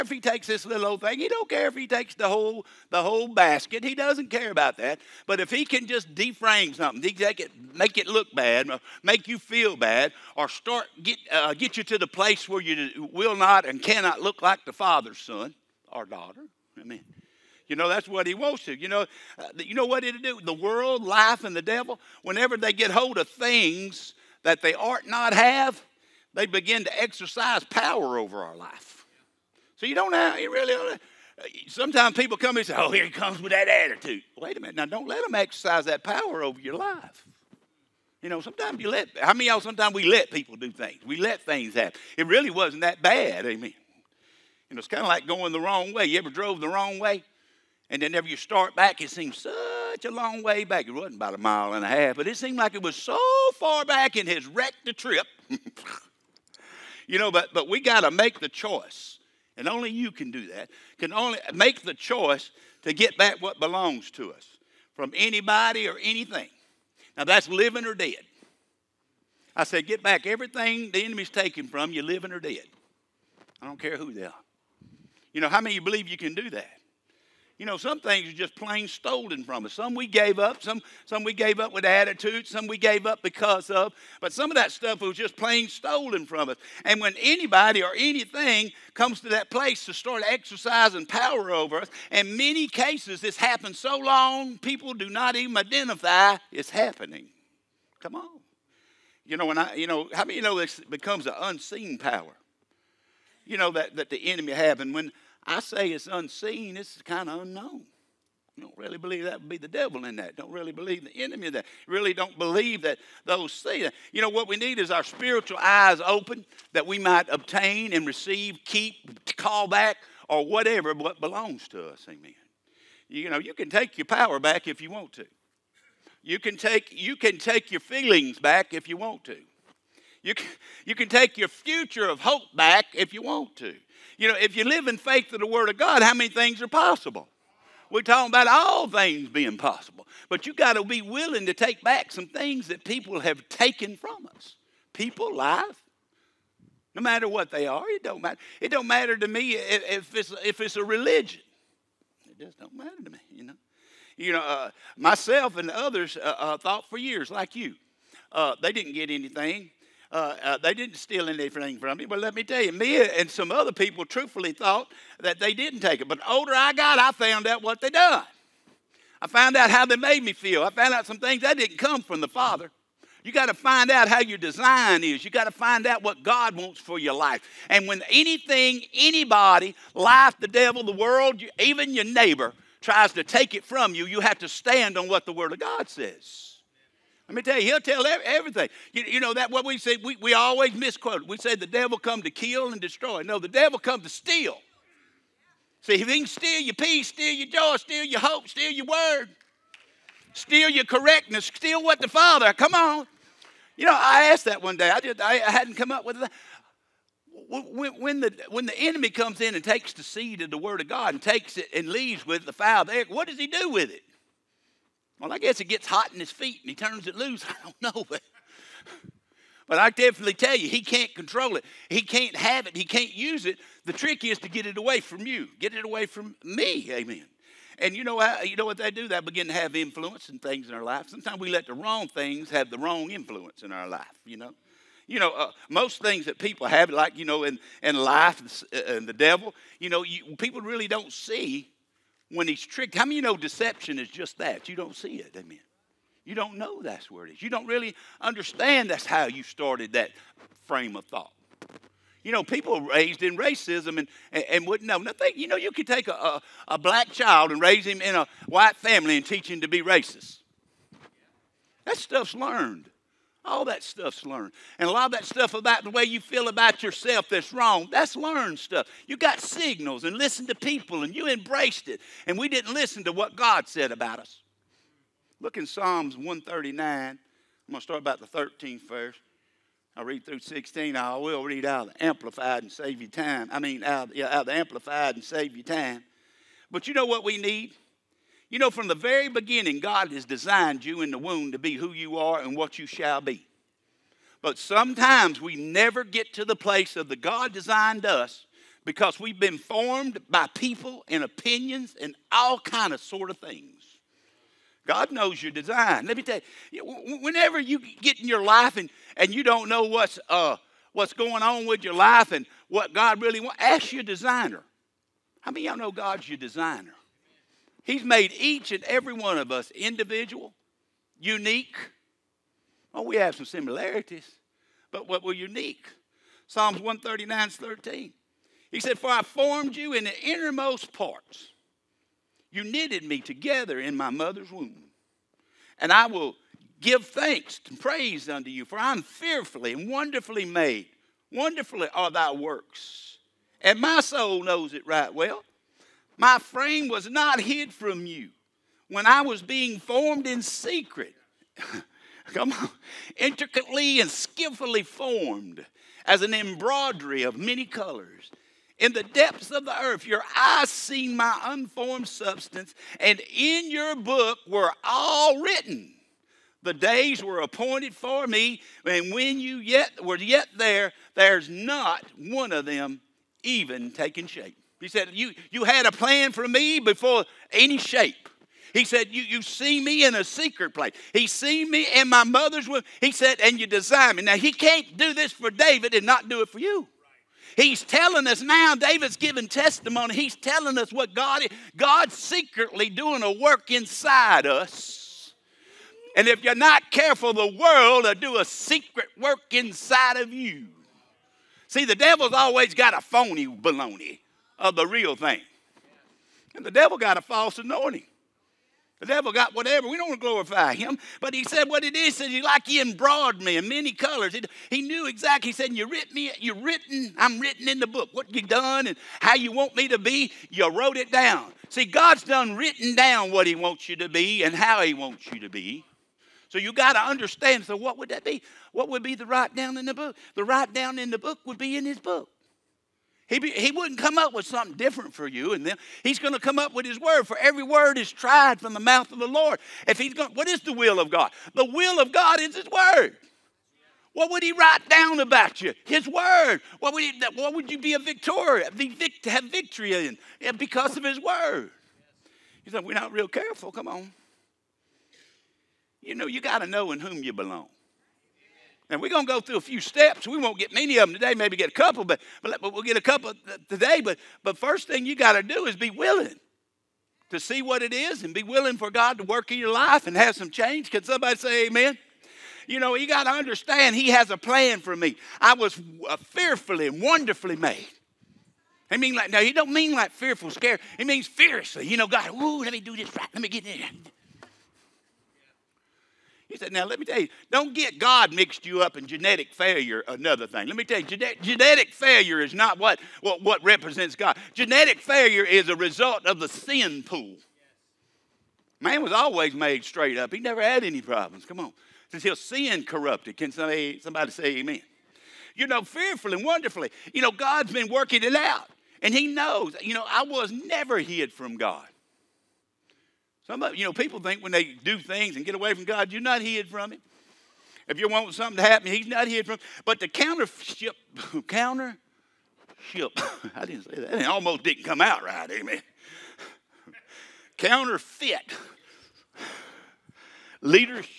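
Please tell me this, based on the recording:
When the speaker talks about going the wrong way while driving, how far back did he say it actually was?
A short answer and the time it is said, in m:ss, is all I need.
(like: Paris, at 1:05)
a mile and a half, at 0:51.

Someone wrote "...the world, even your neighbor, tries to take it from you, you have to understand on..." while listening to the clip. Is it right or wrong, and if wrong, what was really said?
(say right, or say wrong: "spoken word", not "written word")
wrong: "stand", not "understand".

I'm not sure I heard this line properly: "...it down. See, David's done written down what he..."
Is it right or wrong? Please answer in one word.
wrong.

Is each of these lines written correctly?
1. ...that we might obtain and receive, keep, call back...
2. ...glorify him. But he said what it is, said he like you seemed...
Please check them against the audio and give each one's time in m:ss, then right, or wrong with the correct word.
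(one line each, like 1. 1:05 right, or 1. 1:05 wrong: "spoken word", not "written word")
1. 1:56 right
2. 6:50 wrong: "embroidered", not "seemed".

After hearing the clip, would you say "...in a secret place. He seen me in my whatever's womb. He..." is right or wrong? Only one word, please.
wrong.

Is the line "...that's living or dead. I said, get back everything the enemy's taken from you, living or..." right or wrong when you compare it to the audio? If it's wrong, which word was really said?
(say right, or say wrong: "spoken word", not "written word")
right.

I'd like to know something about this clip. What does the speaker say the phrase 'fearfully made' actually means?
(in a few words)
fiercely.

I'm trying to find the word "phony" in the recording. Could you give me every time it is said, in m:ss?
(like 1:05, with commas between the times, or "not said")
6:43.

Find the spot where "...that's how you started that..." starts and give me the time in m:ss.
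4:08.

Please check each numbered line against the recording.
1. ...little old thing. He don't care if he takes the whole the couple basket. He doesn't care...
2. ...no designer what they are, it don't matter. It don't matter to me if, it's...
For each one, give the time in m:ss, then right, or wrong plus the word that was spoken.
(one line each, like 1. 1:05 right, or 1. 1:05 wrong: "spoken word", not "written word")
1. 0:00 wrong: "whole", not "couple"
2. 2:26 wrong: "matter", not "designer".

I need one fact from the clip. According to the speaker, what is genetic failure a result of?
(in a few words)
the sin pool.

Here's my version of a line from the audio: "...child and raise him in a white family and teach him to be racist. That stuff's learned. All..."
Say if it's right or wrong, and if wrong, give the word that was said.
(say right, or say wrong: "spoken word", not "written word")
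right.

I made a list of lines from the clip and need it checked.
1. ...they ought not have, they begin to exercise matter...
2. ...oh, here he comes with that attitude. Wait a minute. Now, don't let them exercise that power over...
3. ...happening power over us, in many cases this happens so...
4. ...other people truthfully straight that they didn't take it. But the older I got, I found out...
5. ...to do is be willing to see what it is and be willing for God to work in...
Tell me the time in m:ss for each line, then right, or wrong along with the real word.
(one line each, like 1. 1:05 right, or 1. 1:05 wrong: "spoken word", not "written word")
1. 0:24 wrong: "power", not "matter"
2. 0:32 right
3. 1:30 wrong: "exercising", not "happening"
4. 2:43 wrong: "thought", not "straight"
5. 7:45 right.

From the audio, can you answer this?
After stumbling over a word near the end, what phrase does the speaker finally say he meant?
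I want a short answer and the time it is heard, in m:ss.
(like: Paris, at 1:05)
counterfeit leadership, at 8:47.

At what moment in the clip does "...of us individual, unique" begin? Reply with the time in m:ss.
5:19.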